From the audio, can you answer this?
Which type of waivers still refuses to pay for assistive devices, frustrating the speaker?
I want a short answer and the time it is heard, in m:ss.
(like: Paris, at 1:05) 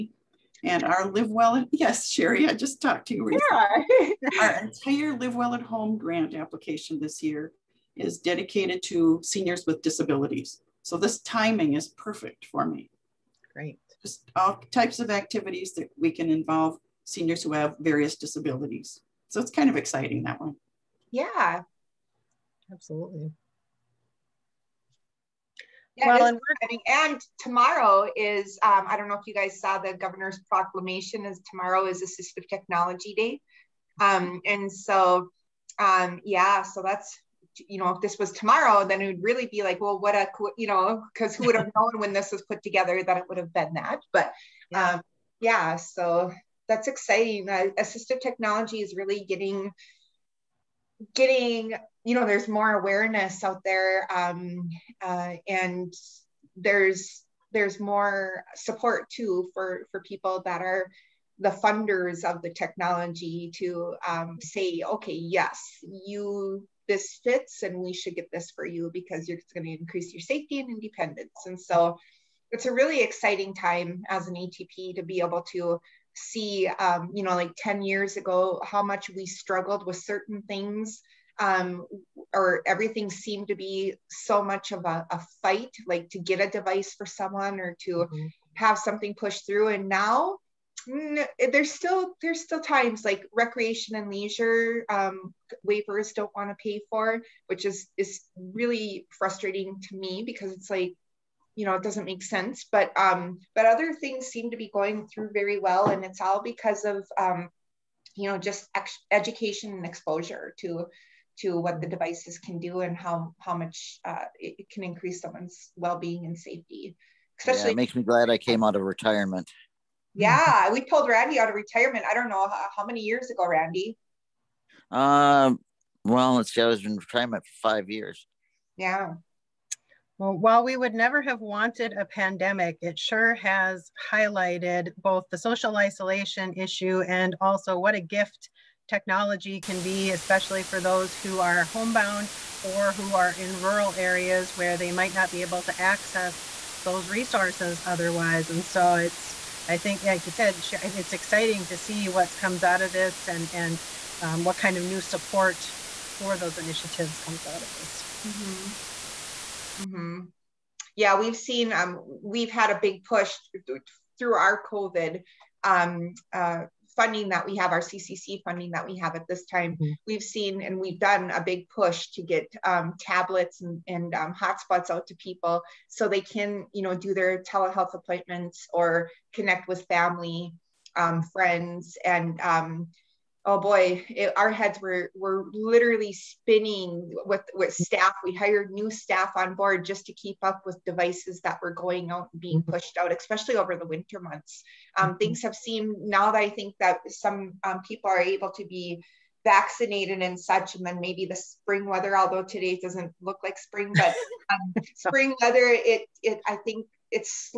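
Recreation and leisure, at 1:33.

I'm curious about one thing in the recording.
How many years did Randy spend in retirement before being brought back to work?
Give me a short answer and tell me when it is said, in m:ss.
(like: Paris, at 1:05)
5, at 2:07.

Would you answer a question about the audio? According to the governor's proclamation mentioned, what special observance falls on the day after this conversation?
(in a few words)
Assistive Technology Day.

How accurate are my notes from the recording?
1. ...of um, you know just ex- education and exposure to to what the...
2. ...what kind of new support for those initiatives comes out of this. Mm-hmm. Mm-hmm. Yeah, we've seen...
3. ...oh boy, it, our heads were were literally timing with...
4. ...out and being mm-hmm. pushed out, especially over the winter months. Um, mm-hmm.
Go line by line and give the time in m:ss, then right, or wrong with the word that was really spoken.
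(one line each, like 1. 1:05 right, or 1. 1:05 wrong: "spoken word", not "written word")
1. 1:46 right
2. 2:34 right
3. 3:03 wrong: "spinning", not "timing"
4. 3:12 right.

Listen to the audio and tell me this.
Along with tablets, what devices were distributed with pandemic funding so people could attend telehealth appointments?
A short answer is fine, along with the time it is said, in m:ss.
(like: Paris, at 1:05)
Hotspots, at 2:54.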